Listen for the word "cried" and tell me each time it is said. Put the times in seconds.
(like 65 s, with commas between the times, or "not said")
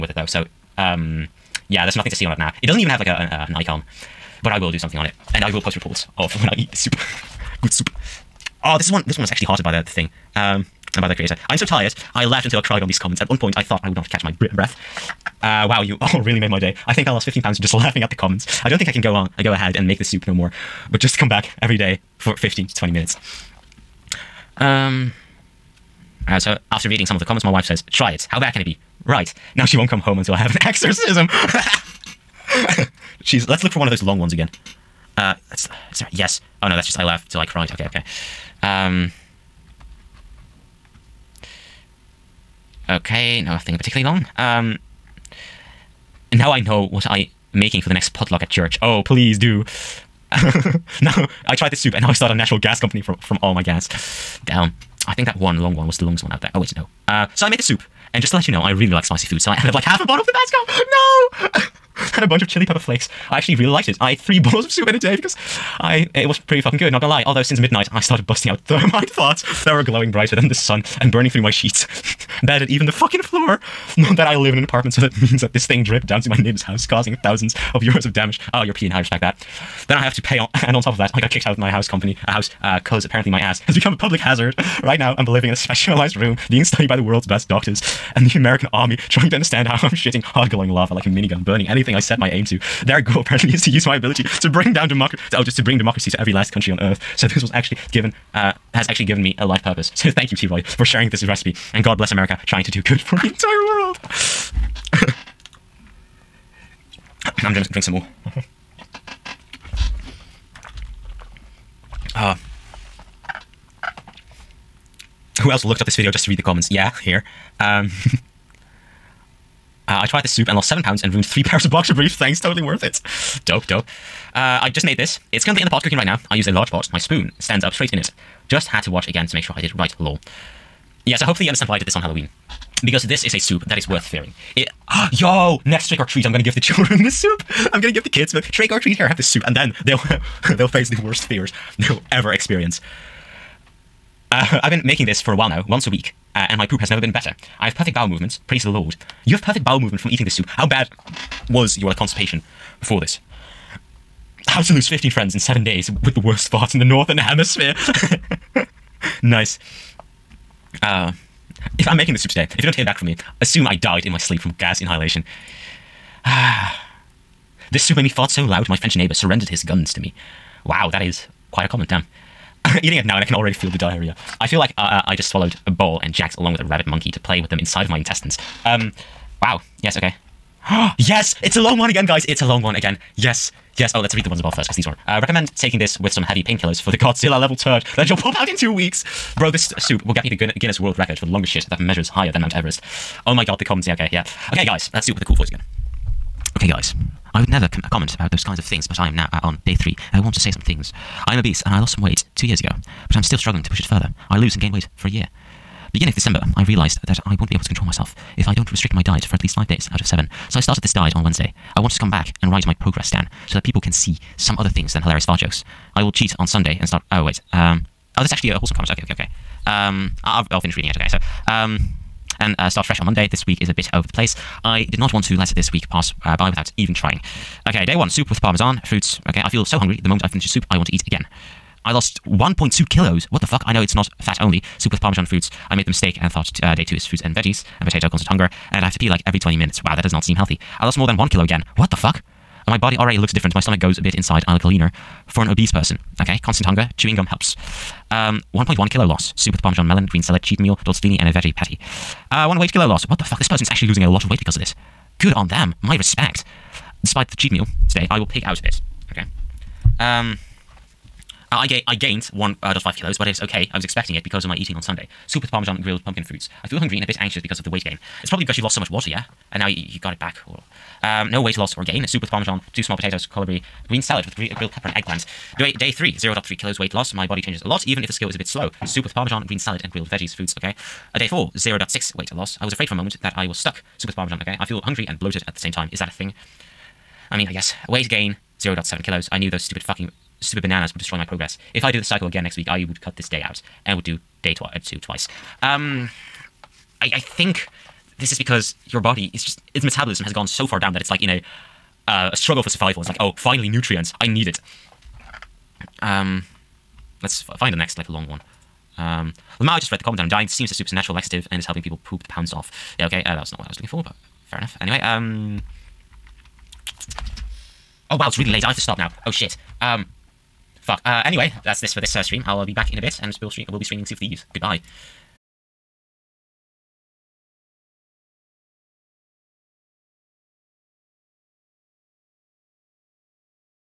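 12 s, 37 s.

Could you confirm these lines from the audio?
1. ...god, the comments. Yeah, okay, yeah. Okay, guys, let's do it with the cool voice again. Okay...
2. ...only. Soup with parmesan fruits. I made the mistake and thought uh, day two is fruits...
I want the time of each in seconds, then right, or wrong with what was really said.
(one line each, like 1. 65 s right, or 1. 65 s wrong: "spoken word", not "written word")
1. 193 s right
2. 234 s right.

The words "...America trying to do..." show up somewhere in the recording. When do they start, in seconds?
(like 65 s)
102 s.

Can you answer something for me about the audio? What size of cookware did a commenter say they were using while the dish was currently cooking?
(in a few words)
large pot.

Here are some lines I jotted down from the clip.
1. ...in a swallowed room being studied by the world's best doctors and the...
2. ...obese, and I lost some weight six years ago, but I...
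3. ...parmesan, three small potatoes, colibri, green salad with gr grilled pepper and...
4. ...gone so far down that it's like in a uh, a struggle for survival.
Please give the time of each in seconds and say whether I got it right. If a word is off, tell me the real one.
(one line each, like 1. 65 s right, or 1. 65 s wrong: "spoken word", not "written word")
1. 85 s wrong: "specialized", not "swallowed"
2. 201 s wrong: "two", not "six"
3. 272 s wrong: "two", not "three"
4. 300 s right.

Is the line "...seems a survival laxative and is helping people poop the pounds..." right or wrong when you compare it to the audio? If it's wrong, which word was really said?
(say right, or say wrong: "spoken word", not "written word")
wrong: "supernatural", not "survival".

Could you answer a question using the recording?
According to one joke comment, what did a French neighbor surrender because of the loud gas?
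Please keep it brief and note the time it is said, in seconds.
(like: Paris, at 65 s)
his guns, at 169 s.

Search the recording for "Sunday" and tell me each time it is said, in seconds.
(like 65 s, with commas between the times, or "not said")
216 s, 264 s.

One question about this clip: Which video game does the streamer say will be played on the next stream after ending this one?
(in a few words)
Sea of Thieves.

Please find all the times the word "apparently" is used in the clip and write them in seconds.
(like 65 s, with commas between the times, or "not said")
83 s, 93 s.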